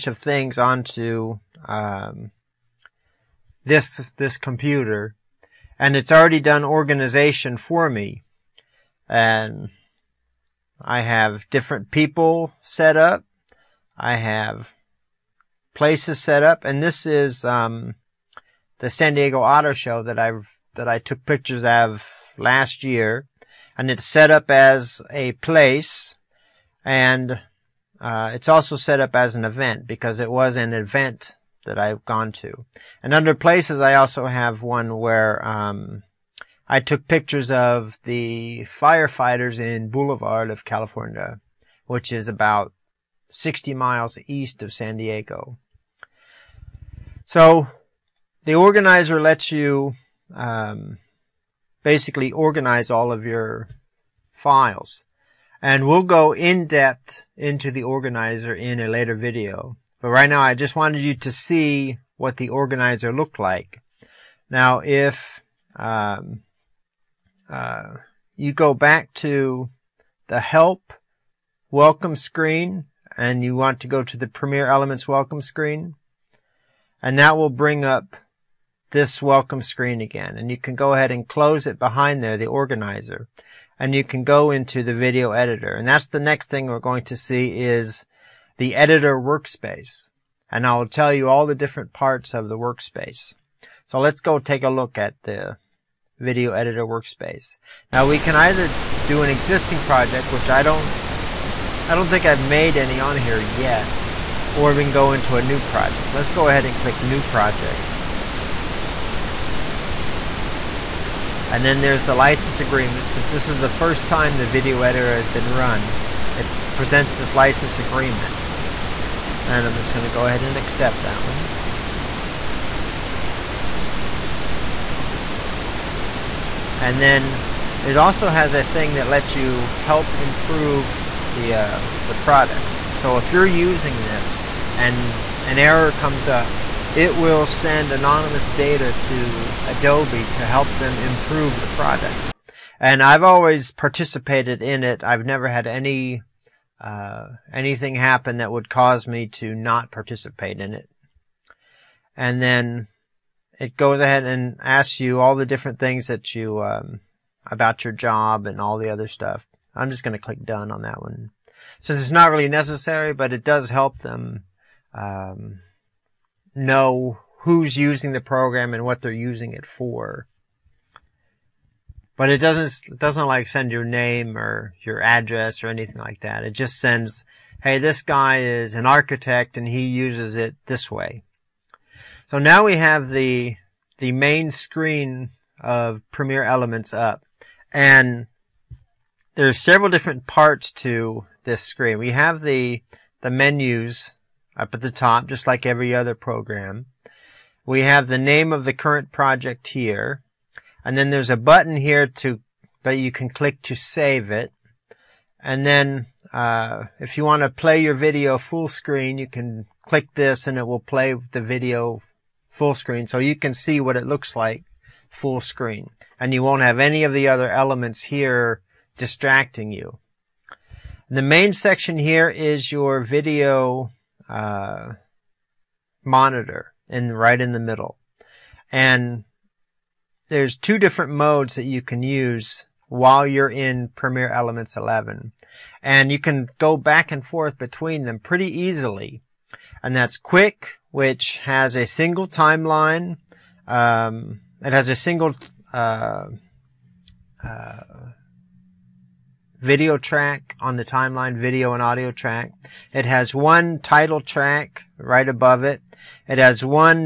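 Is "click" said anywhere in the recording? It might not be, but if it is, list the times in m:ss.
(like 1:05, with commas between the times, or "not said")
1:46, 2:40, 3:23, 3:29.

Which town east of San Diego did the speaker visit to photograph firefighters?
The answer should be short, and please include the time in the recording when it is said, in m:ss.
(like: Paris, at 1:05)
Boulevard, at 0:39.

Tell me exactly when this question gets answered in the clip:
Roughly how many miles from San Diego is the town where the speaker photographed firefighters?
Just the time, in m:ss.
0:43.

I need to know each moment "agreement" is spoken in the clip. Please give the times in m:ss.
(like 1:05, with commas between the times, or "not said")
1:52, 1:57.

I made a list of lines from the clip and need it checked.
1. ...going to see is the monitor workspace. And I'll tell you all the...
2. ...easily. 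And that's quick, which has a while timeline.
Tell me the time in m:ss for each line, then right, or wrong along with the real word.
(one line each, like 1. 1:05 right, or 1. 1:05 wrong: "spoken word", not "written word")
1. 1:26 wrong: "editor", not "monitor"
2. 3:58 wrong: "single", not "while".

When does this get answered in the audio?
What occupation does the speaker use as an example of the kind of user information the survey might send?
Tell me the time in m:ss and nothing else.
2:58.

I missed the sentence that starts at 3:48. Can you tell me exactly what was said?
And there's two different modes that you can use while you're in Premiere Elements 11.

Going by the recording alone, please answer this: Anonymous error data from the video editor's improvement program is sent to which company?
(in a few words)
Adobe.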